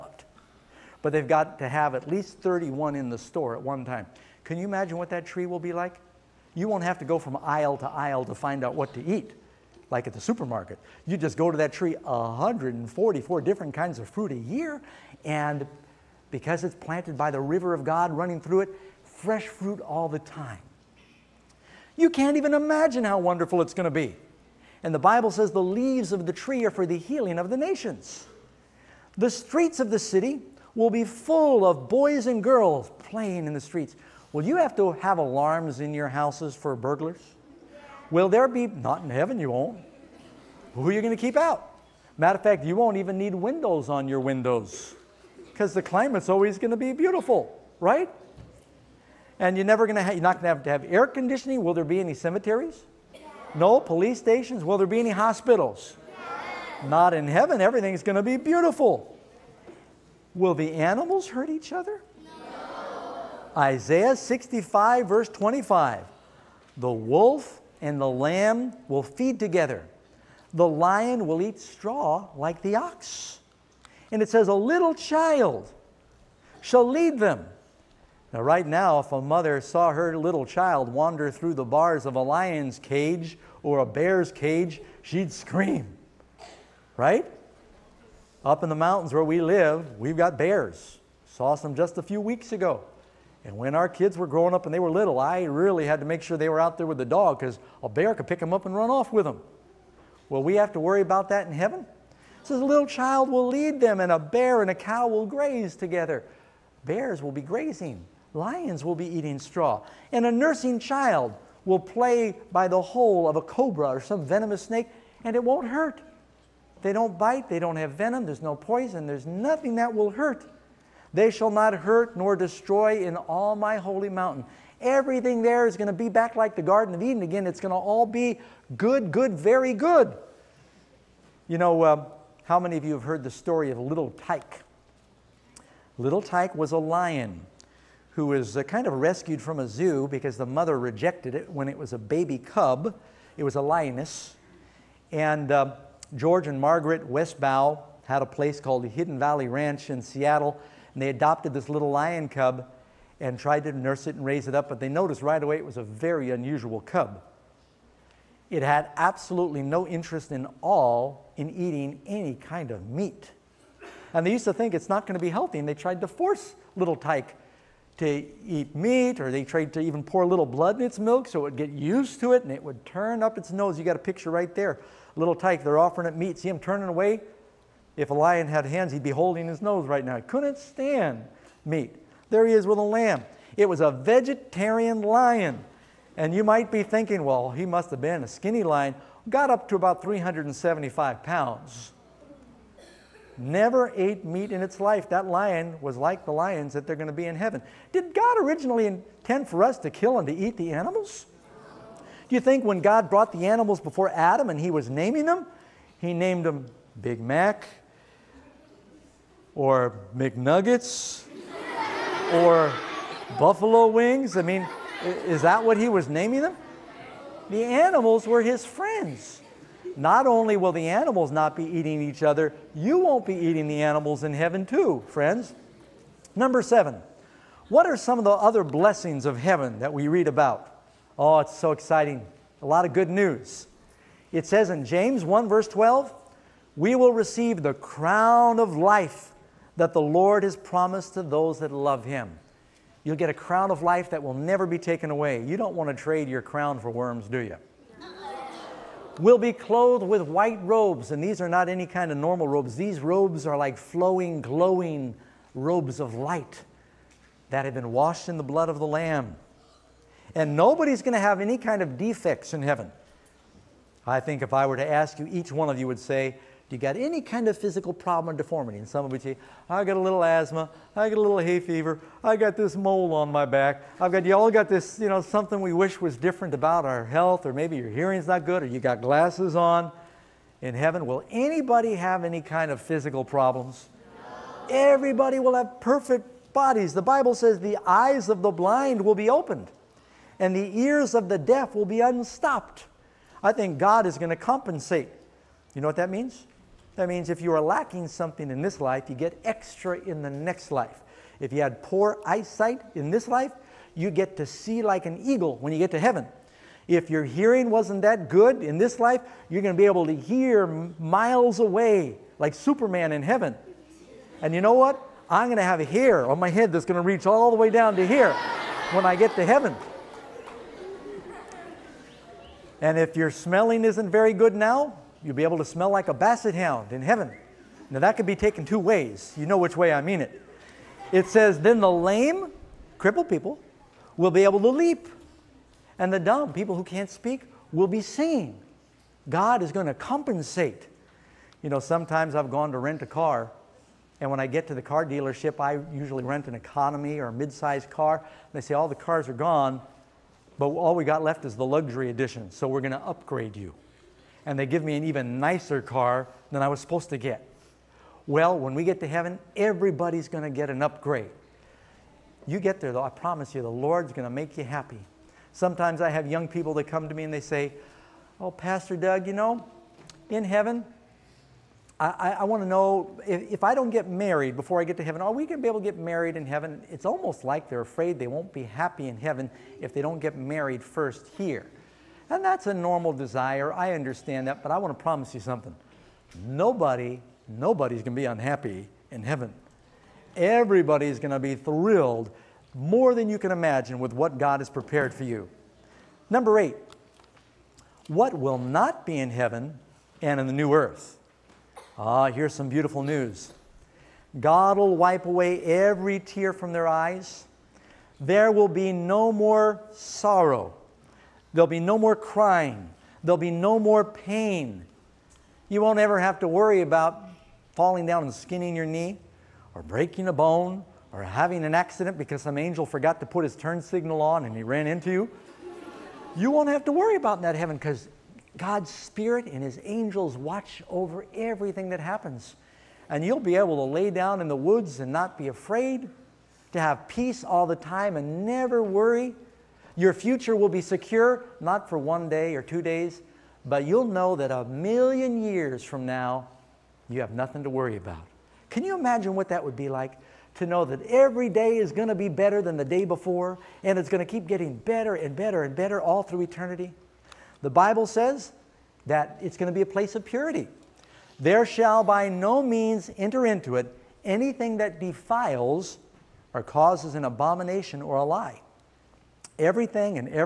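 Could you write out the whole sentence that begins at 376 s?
It's almost like they're afraid they won't be happy in heaven if they don't get married first here.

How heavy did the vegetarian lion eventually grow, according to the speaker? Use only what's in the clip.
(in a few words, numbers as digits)
375 pounds.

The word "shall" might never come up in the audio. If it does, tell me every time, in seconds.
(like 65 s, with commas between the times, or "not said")
76 s, 121 s, 461 s.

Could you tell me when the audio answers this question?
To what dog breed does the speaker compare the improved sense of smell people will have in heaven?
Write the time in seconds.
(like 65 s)
326 s.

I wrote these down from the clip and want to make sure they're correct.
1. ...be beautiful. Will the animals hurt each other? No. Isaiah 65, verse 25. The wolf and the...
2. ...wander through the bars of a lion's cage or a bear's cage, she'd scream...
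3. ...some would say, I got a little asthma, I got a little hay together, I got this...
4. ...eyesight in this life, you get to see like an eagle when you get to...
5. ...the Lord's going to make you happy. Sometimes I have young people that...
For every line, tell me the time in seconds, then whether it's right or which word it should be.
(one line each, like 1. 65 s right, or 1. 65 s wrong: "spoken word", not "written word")
1. 58 s right
2. 80 s right
3. 268 s wrong: "fever", not "together"
4. 302 s right
5. 363 s right.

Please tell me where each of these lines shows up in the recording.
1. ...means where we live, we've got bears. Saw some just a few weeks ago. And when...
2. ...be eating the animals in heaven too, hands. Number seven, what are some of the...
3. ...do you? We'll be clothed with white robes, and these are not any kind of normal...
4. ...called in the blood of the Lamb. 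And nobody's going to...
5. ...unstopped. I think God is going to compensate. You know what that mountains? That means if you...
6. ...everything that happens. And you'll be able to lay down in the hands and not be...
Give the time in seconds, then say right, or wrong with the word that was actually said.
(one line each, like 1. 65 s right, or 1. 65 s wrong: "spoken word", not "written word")
1. 88 s wrong: "mountains", not "means"
2. 223 s wrong: "friends", not "hands"
3. 247 s right
4. 257 s wrong: "washed", not "called"
5. 292 s wrong: "means", not "mountains"
6. 431 s wrong: "woods", not "hands".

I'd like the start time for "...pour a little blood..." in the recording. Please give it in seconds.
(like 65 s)
170 s.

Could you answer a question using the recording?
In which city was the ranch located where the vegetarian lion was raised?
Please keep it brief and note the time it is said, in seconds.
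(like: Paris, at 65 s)
Seattle, at 150 s.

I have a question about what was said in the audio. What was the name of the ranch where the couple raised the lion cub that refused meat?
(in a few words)
Hidden Valley Ranch.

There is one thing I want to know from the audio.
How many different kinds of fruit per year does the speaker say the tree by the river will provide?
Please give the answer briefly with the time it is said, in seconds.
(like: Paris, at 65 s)
144, at 12 s.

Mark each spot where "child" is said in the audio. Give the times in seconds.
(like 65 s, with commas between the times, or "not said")
74 s, 80 s, 102 s, 110 s.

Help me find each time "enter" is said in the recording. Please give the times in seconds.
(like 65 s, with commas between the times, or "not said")
463 s.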